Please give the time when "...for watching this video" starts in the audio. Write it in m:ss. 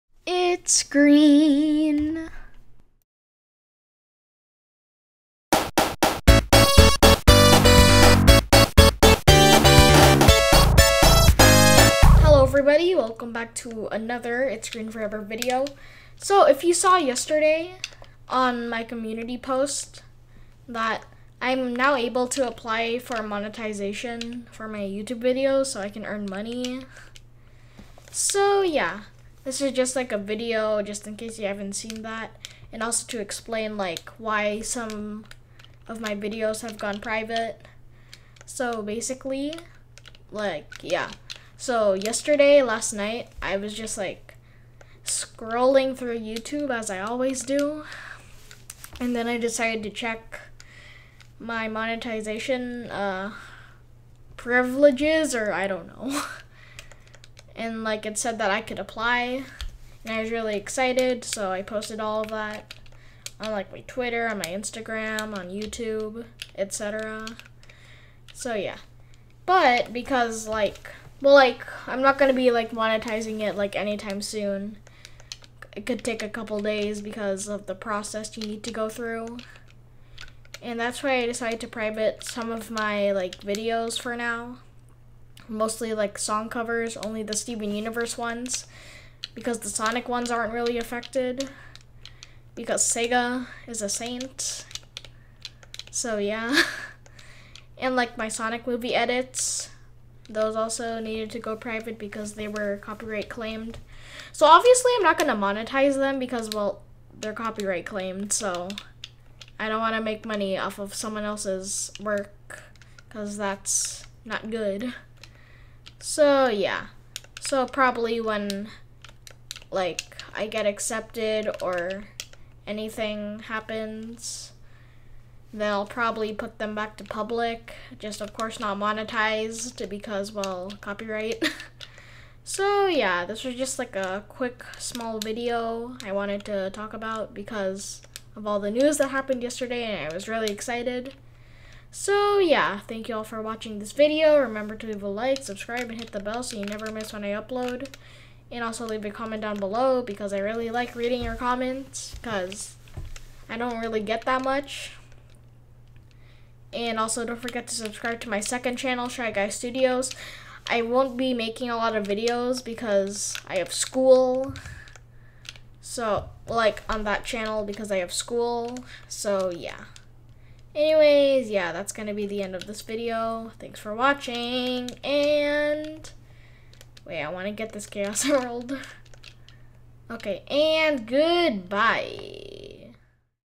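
2:23.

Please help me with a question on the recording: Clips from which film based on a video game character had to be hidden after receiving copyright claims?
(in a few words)
Sonic movie.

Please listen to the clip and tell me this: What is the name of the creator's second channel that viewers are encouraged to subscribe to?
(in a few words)
Shy Guy Studios.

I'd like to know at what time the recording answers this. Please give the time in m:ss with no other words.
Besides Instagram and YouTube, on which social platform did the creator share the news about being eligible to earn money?
1:03.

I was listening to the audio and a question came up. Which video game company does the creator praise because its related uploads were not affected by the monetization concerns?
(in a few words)
Sega.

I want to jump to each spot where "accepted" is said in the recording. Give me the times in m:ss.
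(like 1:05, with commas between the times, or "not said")
2:00.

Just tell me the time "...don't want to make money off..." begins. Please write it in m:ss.
1:49.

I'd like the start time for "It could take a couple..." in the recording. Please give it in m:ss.
1:15.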